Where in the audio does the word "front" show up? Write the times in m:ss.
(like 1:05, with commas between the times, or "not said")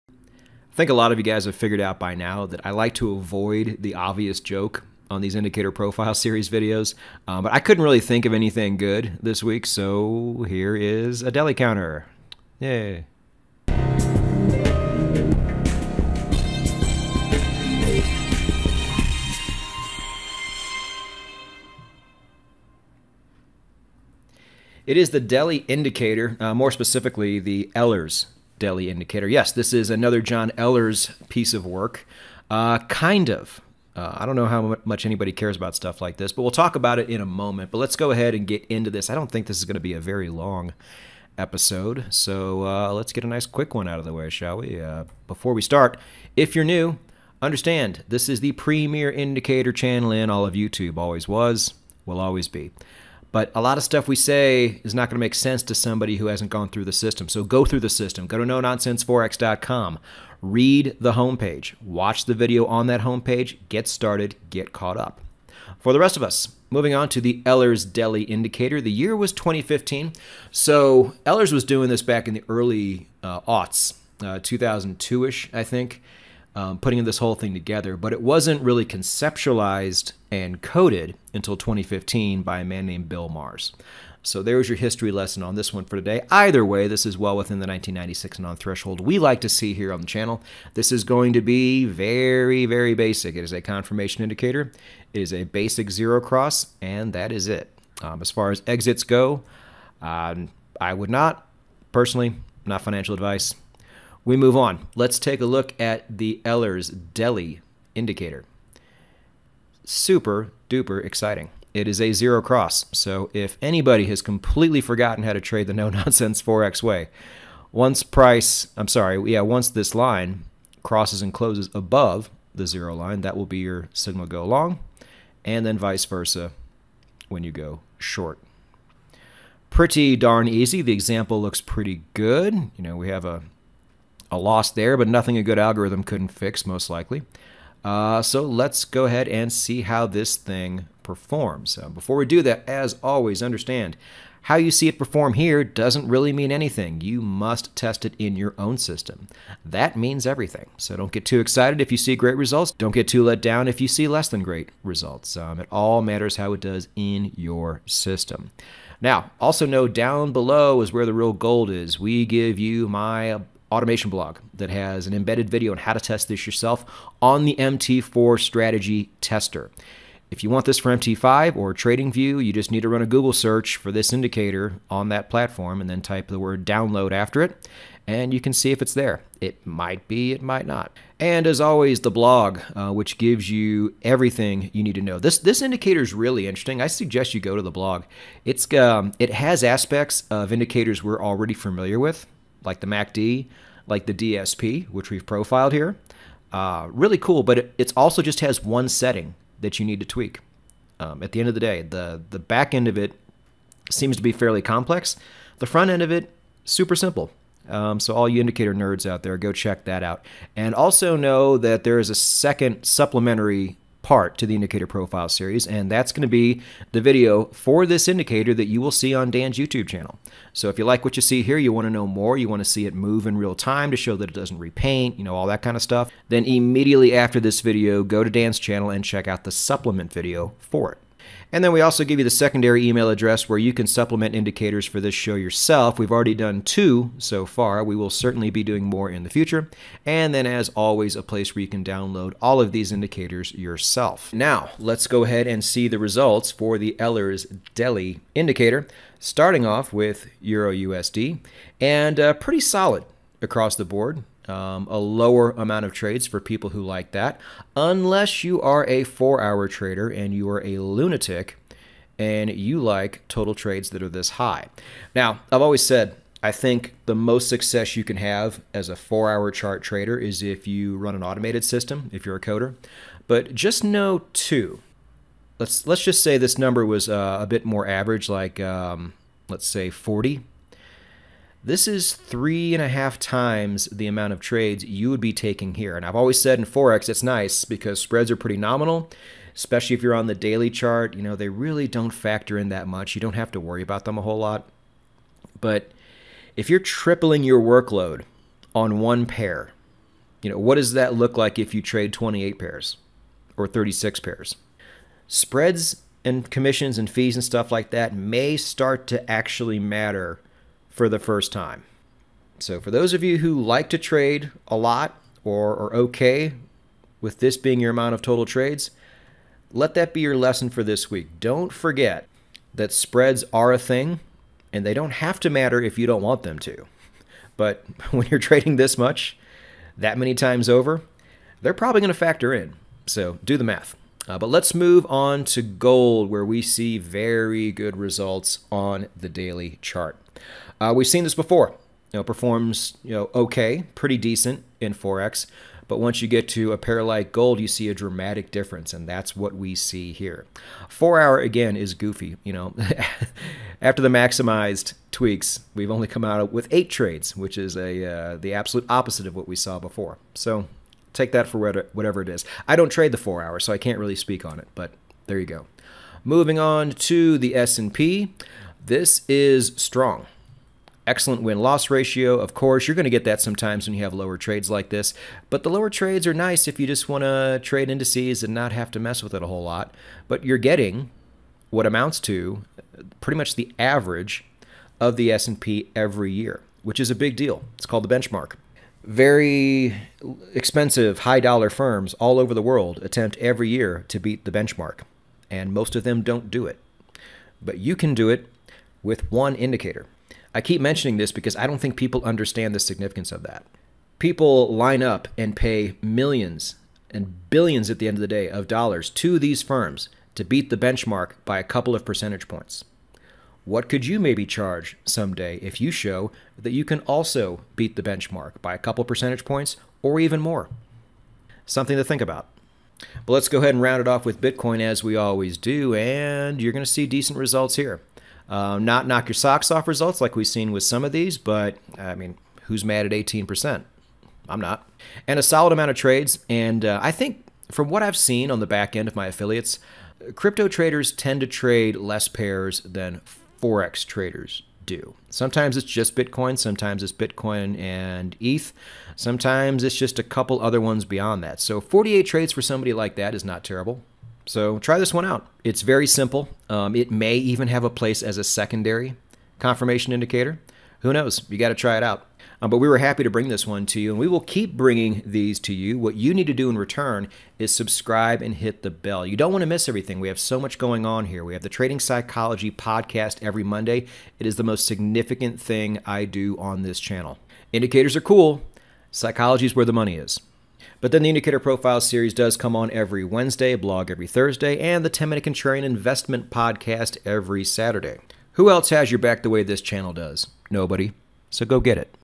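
3:25.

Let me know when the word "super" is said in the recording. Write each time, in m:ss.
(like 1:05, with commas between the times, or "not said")
1:49, 3:26.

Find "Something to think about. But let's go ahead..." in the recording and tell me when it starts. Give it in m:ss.
7:01.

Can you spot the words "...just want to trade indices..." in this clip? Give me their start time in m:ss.
6:16.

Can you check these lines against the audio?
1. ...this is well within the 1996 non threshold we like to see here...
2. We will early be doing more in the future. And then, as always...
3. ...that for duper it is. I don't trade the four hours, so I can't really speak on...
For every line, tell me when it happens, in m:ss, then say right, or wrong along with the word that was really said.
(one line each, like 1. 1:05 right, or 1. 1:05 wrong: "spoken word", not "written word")
1. 1:26 right
2. 3:57 wrong: "certainly", not "early"
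3. 6:01 wrong: "whatever", not "duper".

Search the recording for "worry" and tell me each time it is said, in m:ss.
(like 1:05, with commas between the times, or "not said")
4:53.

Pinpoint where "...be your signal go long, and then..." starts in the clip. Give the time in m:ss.
2:03.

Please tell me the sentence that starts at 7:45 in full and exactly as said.
What you need to do in return is subscribe and hit the bell.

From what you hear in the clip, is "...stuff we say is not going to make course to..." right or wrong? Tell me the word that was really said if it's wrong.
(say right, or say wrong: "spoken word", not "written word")
wrong: "sense", not "course".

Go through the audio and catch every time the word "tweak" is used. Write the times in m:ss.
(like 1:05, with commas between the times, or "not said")
3:20, 5:55.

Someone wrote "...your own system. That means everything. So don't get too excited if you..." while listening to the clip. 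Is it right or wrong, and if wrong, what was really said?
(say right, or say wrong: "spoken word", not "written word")
right.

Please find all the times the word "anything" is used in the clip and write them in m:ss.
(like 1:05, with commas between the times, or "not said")
0:08, 2:26.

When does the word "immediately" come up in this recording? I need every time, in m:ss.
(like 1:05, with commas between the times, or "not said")
3:46.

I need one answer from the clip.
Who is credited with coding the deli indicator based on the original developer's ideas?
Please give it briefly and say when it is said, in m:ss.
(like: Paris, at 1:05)
Bill Mars, at 1:23.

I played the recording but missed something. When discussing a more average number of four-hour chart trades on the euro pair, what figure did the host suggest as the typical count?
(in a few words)
40.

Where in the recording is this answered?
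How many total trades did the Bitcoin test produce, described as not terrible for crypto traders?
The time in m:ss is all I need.
7:31.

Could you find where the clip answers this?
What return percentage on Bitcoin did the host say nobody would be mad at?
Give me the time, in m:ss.
7:13.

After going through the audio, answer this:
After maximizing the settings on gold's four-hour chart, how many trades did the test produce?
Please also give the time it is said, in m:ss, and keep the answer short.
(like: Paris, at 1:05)
8, at 5:56.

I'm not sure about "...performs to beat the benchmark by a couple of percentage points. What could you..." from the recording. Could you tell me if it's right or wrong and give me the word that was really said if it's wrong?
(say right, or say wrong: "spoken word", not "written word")
wrong: "firms", not "performs".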